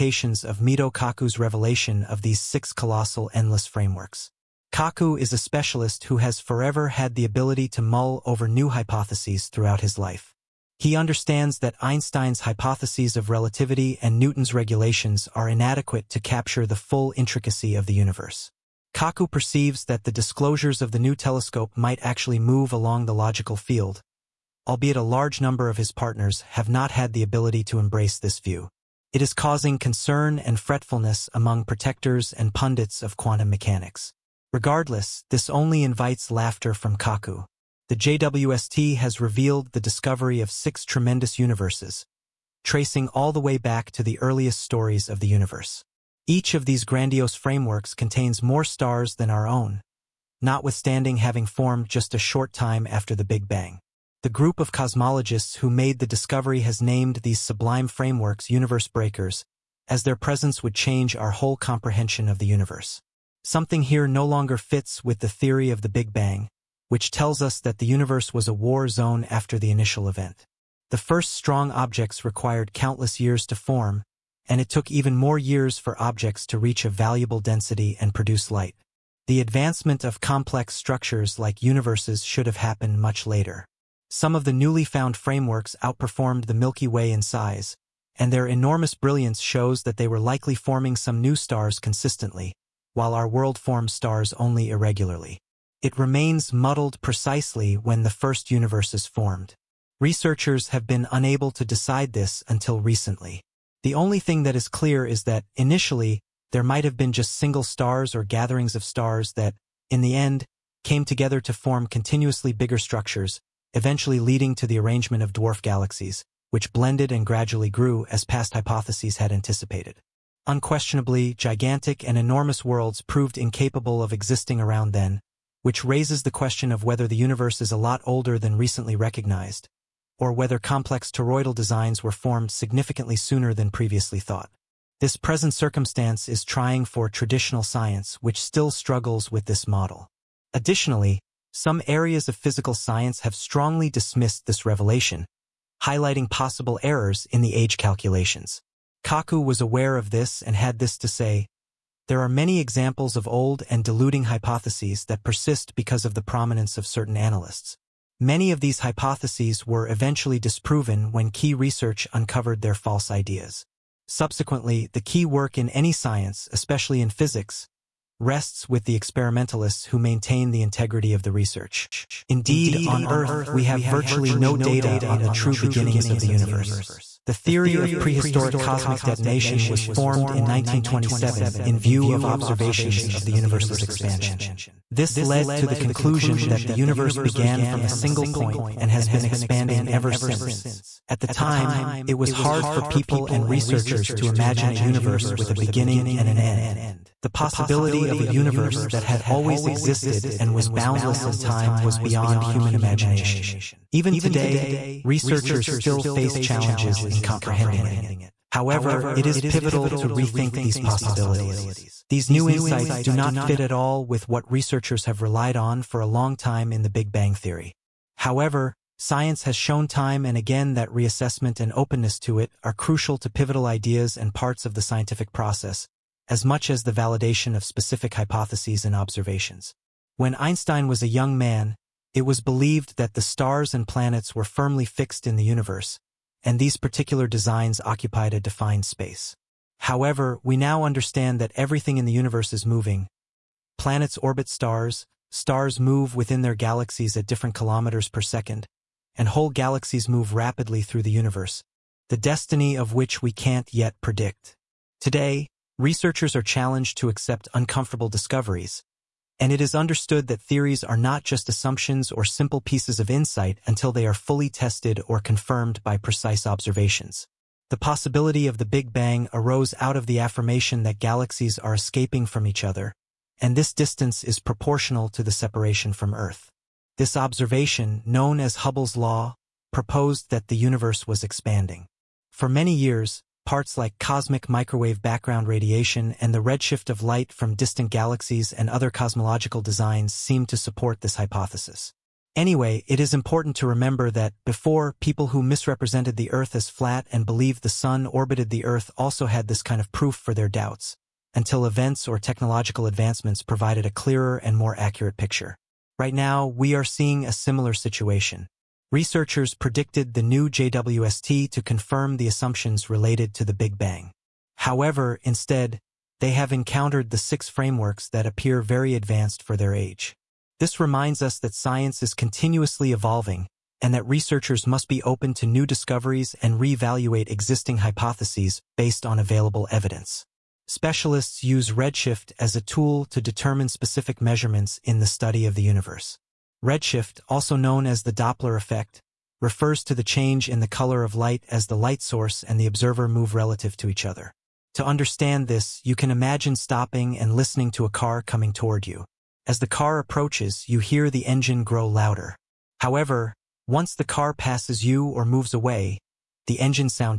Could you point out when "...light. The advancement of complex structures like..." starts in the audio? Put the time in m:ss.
1:18.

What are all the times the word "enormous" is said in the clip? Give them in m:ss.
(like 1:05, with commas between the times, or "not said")
1:28, 2:02.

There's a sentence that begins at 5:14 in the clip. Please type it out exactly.
However, instead, they have encountered the six frameworks that appear very advanced for their age.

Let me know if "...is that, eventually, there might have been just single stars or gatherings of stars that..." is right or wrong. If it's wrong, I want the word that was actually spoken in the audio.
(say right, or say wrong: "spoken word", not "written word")
wrong: "initially", not "eventually".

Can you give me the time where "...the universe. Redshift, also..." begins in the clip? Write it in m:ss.
5:35.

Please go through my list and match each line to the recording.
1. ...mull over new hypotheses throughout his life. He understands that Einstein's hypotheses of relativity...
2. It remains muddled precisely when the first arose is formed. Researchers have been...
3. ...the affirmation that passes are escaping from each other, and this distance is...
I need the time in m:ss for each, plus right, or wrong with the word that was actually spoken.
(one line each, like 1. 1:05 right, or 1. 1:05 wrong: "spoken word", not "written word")
1. 0:07 right
2. 1:35 wrong: "universe", not "arose"
3. 4:30 wrong: "galaxies", not "passes".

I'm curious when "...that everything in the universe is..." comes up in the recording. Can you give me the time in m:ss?
4:01.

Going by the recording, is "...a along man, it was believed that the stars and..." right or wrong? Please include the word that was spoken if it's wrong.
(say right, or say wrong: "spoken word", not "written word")
wrong: "young", not "along".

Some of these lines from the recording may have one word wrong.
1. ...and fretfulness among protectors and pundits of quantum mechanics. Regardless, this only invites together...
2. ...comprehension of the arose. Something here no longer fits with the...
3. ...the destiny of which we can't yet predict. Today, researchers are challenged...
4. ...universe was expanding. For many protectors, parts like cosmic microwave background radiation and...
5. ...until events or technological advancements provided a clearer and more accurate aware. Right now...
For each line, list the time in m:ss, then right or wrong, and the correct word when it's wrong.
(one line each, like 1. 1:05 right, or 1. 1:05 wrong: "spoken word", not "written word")
1. 0:30 wrong: "laughter", not "together"
2. 1:01 wrong: "universe", not "arose"
3. 4:12 right
4. 4:40 wrong: "years", not "protectors"
5. 5:01 wrong: "picture", not "aware".